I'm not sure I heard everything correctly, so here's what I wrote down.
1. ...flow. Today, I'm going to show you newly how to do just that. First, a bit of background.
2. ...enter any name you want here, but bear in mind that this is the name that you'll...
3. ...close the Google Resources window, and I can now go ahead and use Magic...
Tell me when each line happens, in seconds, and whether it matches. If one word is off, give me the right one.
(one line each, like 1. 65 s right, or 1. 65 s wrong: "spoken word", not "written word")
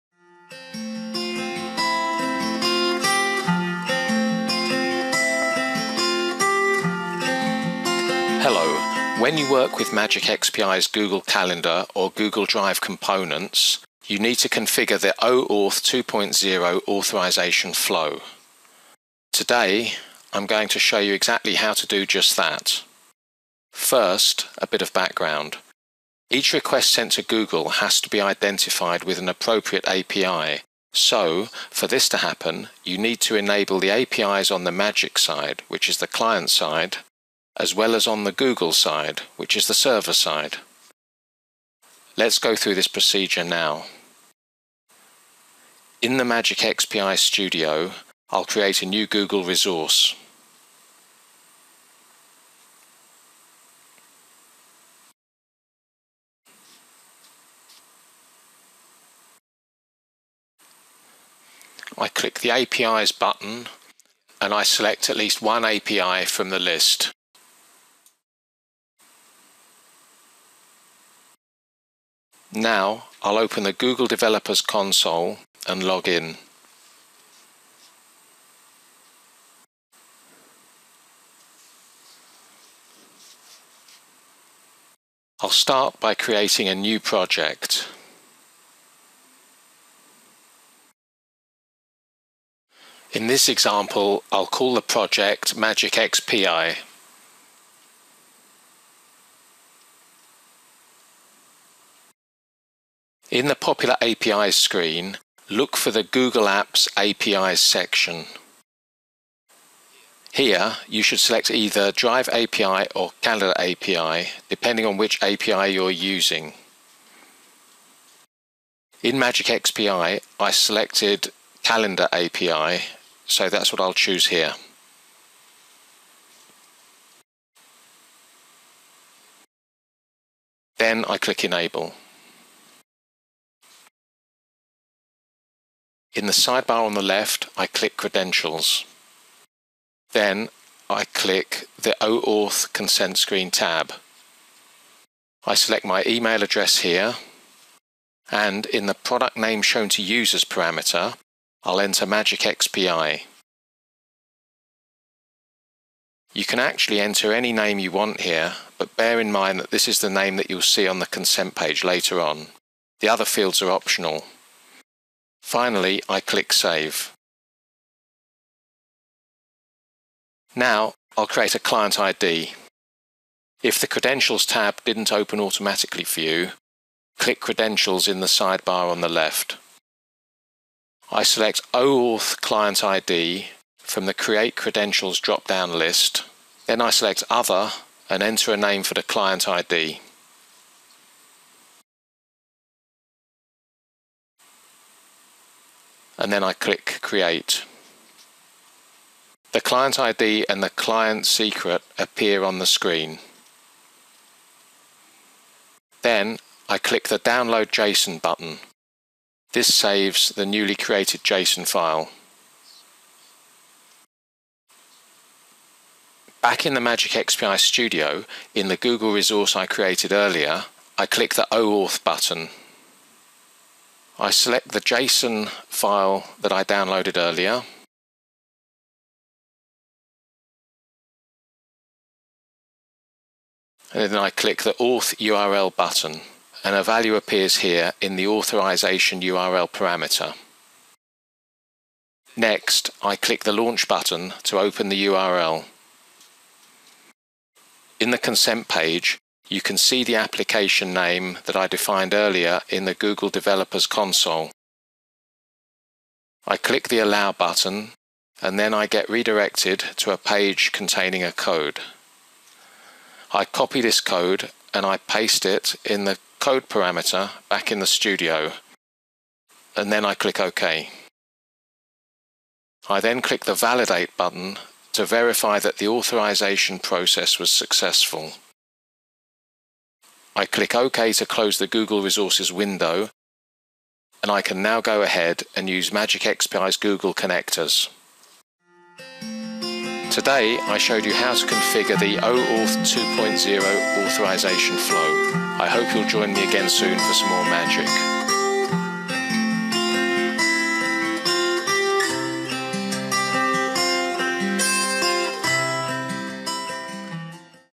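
1. 17 s wrong: "exactly", not "newly"
2. 156 s right
3. 281 s right.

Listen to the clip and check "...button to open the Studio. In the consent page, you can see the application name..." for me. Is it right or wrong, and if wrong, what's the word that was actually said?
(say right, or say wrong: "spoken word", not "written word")
wrong: "URL", not "Studio".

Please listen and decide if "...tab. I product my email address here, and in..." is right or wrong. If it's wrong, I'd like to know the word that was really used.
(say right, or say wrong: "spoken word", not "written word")
wrong: "select", not "product".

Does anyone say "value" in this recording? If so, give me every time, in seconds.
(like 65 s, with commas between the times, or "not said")
236 s.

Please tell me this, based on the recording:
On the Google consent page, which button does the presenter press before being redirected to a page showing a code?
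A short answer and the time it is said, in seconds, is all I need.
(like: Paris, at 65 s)
Allow, at 256 s.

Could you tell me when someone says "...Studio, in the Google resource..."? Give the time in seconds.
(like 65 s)
217 s.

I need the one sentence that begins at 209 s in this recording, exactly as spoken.
This saves the newly created JSON file.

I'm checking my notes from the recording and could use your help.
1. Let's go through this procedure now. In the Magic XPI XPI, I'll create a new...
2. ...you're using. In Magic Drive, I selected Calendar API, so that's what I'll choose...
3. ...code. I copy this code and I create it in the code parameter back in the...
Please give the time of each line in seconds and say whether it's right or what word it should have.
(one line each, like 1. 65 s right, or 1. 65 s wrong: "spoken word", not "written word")
1. 42 s wrong: "Studio", not "XPI"
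2. 115 s wrong: "XPI", not "Drive"
3. 261 s wrong: "paste", not "create".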